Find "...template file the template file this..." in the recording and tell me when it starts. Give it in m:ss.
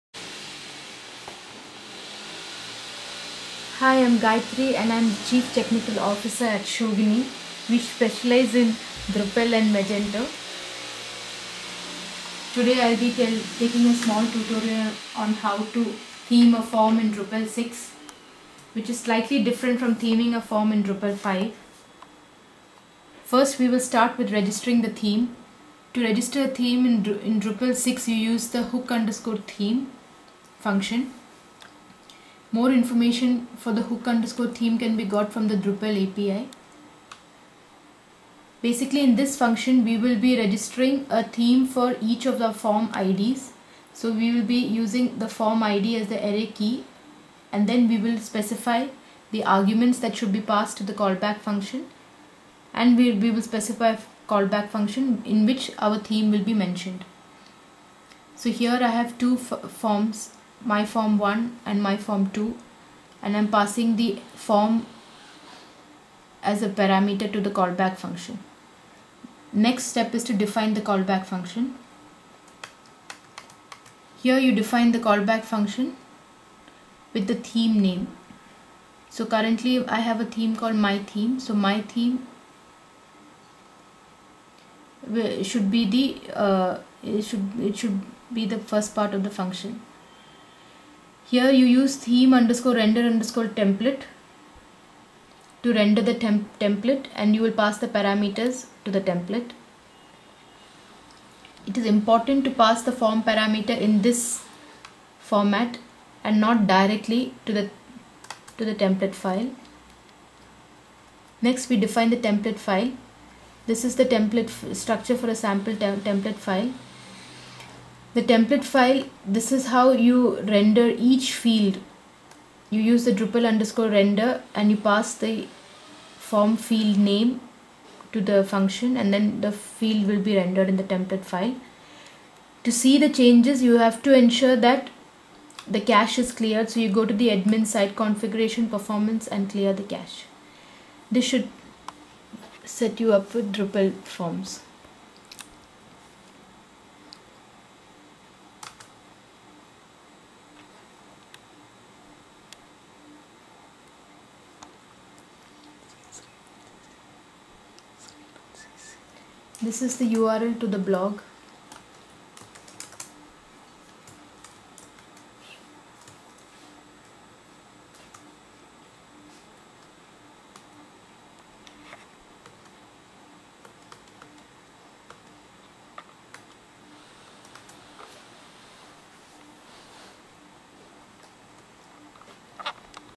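1:56.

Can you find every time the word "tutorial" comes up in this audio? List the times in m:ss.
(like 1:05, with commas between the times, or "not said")
0:14.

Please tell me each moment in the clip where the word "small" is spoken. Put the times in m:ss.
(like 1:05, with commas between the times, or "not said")
0:13.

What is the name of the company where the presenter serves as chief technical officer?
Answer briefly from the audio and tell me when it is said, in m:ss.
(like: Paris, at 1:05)
Schogini, at 0:06.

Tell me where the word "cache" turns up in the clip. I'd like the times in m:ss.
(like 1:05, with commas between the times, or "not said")
2:15, 2:19.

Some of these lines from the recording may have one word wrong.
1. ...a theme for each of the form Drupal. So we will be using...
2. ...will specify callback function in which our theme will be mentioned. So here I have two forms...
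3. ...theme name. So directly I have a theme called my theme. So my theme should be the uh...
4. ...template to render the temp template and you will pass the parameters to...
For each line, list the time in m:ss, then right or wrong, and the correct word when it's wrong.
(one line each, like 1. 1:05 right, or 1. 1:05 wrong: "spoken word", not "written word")
1. 0:41 wrong: "IDs", not "Drupal"
2. 0:53 right
3. 1:17 wrong: "currently", not "directly"
4. 1:33 right.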